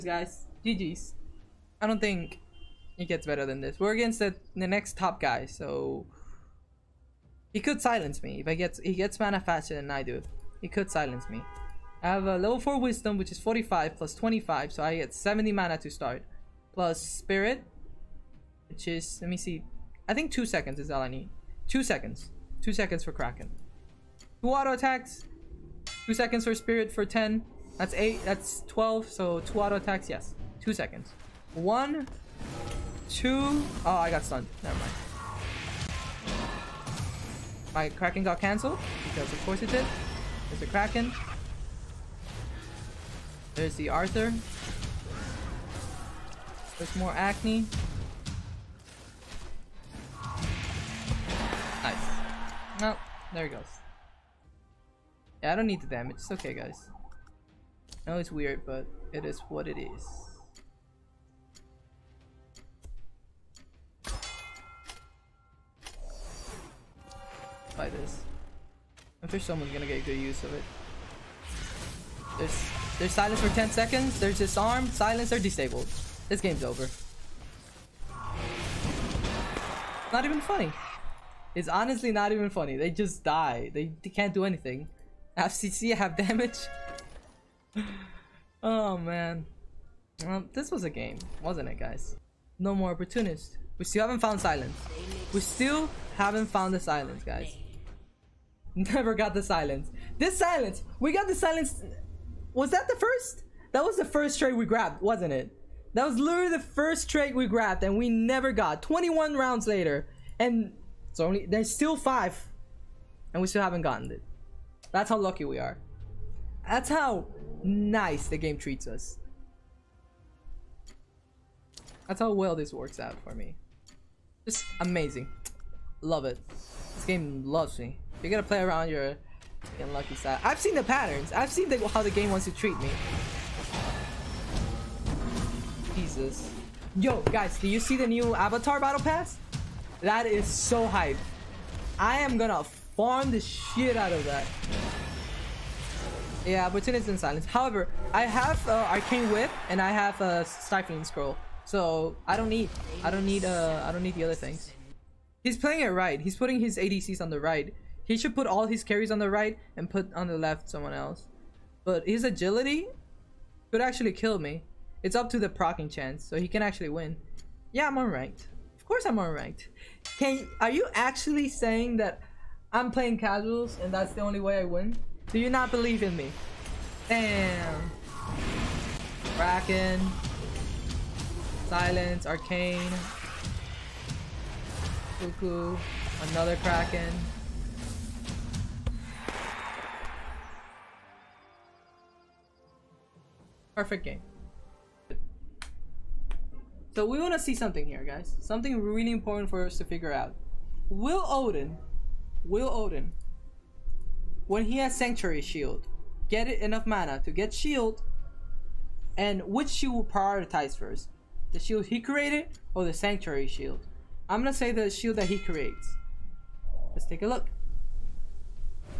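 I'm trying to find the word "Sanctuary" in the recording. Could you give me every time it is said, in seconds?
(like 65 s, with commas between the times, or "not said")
204 s, 212 s.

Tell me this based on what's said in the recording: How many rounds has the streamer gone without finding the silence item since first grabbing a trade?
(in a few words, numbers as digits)
21.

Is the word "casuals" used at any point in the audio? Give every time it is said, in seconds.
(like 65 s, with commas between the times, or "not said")
173 s.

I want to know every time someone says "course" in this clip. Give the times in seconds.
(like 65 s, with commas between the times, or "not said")
39 s, 168 s.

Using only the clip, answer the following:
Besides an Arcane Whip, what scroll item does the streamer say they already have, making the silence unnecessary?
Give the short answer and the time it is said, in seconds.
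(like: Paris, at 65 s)
Stifling Scroll, at 150 s.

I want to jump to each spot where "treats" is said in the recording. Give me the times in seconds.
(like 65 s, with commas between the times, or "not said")
118 s, 132 s.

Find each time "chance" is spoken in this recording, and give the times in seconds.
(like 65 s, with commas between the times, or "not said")
165 s.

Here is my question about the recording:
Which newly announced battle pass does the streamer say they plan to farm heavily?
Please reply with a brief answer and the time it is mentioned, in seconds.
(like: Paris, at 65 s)
Avatar Battle Pass, at 138 s.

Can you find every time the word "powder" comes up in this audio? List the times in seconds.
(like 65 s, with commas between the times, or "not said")
not said.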